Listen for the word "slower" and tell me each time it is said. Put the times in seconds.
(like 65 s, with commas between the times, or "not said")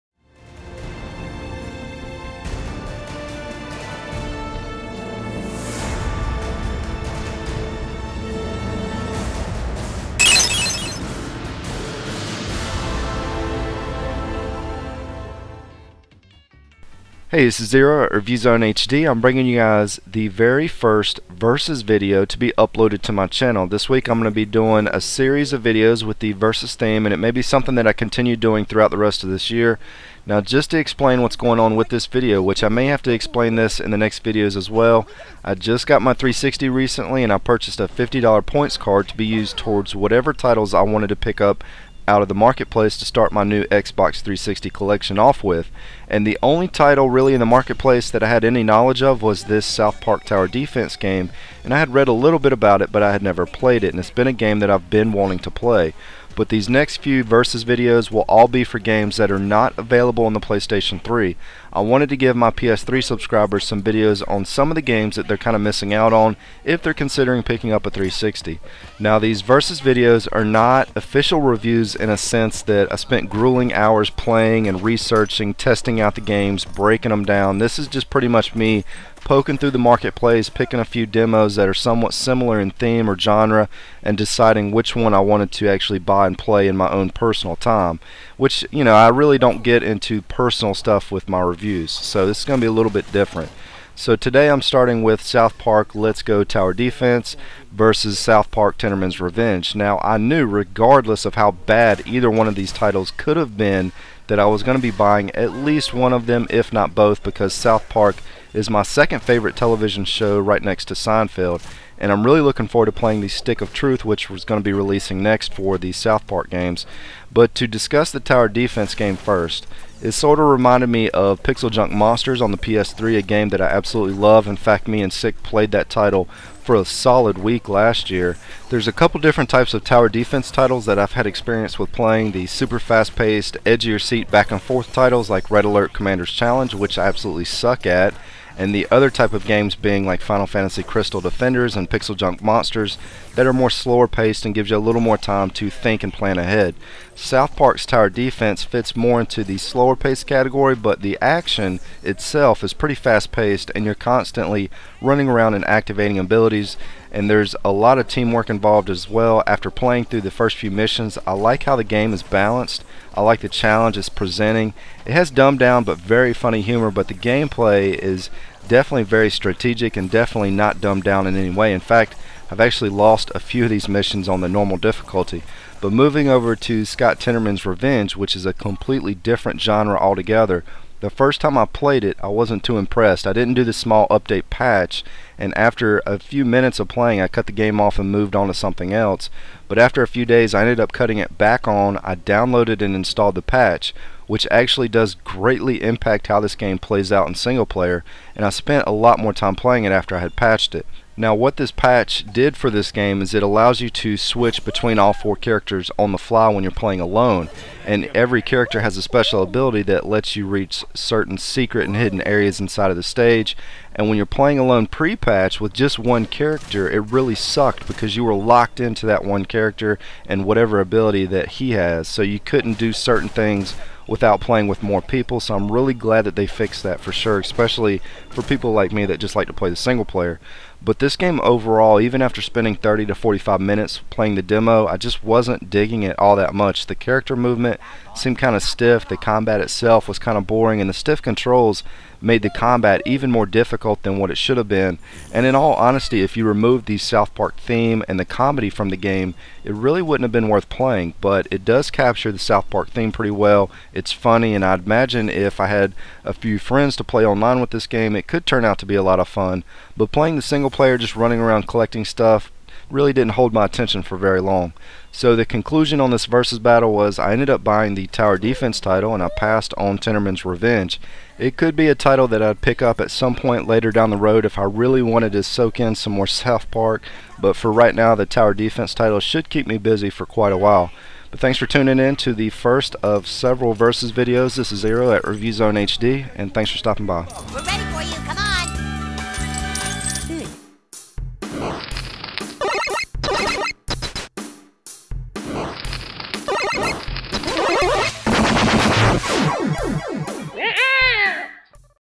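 143 s, 149 s.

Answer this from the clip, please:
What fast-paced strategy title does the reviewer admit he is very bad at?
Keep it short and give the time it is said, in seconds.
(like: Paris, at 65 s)
Red Alert Commander's Challenge, at 135 s.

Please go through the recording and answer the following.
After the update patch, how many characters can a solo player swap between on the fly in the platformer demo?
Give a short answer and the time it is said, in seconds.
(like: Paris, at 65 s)
4, at 205 s.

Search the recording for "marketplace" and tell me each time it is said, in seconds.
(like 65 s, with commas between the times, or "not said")
42 s, 47 s, 79 s.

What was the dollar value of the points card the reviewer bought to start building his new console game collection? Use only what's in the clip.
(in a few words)
$50.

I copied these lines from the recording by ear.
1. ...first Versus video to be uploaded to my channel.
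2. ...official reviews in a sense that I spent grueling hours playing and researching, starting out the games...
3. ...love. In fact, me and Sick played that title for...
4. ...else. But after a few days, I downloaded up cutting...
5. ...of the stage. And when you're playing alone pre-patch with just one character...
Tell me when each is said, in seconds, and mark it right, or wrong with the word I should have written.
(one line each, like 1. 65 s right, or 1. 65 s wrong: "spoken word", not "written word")
1. 20 s right
2. 70 s wrong: "testing", not "starting"
3. 124 s right
4. 188 s wrong: "ended", not "downloaded"
5. 212 s right.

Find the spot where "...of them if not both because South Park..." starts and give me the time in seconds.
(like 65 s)
106 s.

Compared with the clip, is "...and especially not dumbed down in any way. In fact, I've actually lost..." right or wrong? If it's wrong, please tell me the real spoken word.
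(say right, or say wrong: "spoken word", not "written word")
wrong: "definitely", not "especially".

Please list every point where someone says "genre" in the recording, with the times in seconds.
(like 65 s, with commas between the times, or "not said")
83 s, 179 s.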